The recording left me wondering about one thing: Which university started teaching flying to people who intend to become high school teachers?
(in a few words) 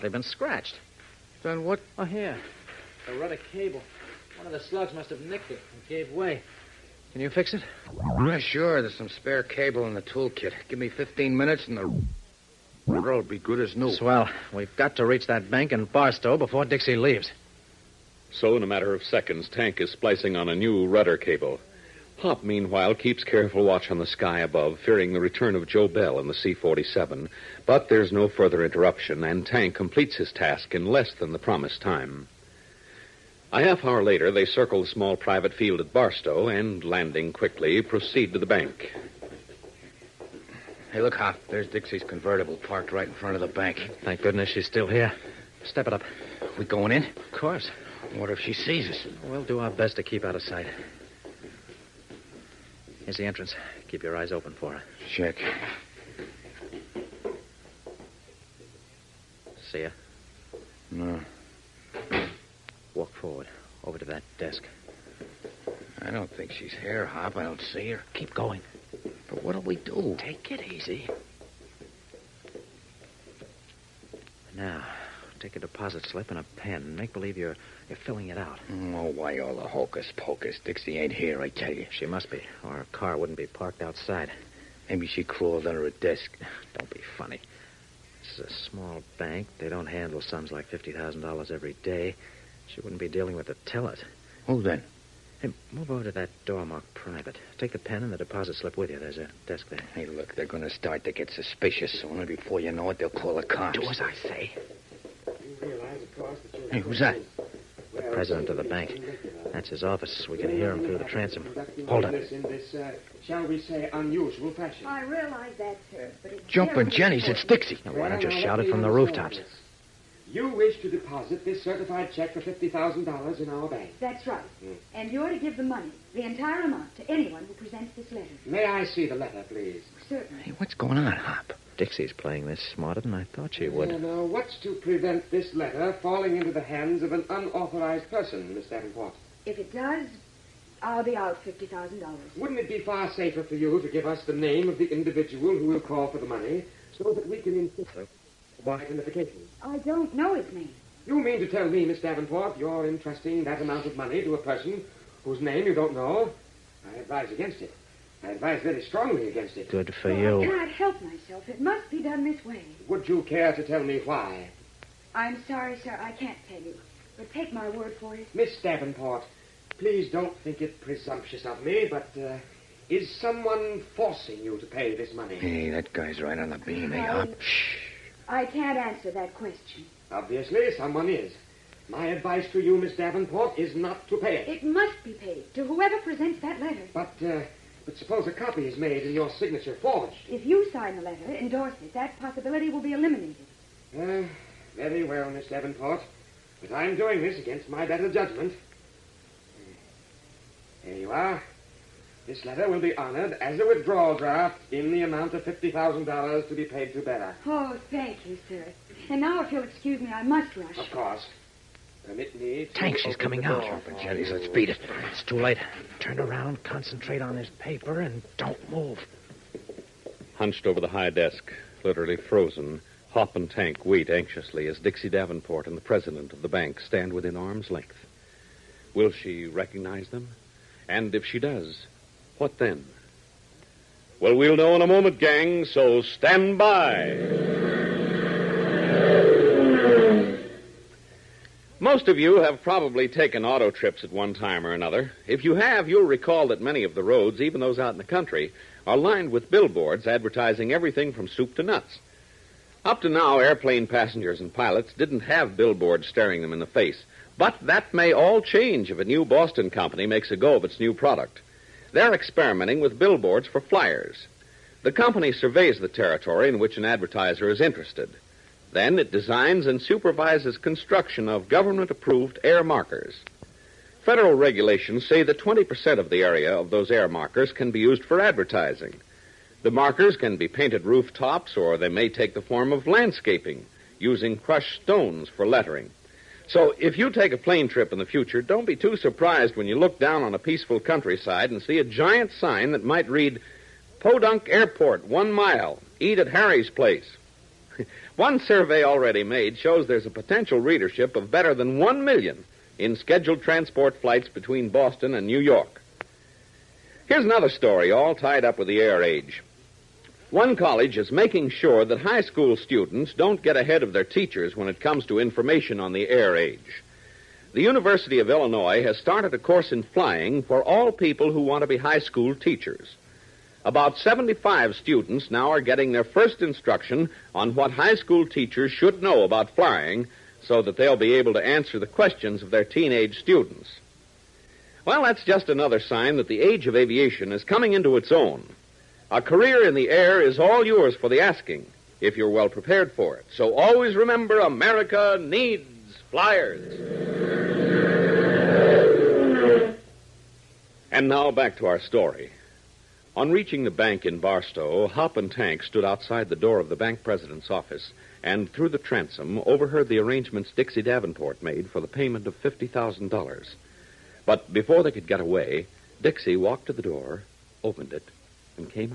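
University of Illinois.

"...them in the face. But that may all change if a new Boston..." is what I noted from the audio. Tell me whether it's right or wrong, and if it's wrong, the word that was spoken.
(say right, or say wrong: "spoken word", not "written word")
right.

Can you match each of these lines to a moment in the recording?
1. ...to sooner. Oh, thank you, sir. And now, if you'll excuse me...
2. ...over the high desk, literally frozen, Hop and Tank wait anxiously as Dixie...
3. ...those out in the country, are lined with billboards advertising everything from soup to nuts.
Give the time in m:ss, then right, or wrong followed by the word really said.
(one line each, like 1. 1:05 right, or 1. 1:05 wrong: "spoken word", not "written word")
1. 3:26 wrong: "bearer", not "sooner"
2. 3:40 right
3. 4:07 right.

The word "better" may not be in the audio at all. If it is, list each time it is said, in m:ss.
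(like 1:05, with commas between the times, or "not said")
3:17, 5:01.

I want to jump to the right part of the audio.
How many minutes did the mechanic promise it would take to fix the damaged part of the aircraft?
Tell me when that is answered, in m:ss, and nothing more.
0:10.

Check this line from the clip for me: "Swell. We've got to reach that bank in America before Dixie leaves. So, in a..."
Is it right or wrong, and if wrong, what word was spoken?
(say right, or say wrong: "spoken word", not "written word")
wrong: "Barstow", not "America".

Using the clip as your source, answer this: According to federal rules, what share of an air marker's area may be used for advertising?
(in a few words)
20%.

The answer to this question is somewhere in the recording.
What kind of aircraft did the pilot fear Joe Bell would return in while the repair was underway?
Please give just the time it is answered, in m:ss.
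0:26.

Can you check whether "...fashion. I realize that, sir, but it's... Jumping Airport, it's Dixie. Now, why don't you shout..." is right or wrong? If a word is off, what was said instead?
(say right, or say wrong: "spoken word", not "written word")
wrong: "Jennies", not "Airport".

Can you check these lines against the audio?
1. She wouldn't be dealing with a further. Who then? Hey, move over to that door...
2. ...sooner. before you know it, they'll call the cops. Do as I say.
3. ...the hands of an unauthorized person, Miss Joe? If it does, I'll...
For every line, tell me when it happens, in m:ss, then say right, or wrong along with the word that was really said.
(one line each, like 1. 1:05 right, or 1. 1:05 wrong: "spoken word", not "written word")
1. 1:32 wrong: "teller", not "further"
2. 1:42 right
3. 2:16 wrong: "Davenport", not "Joe".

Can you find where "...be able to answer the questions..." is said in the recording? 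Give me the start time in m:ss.
5:30.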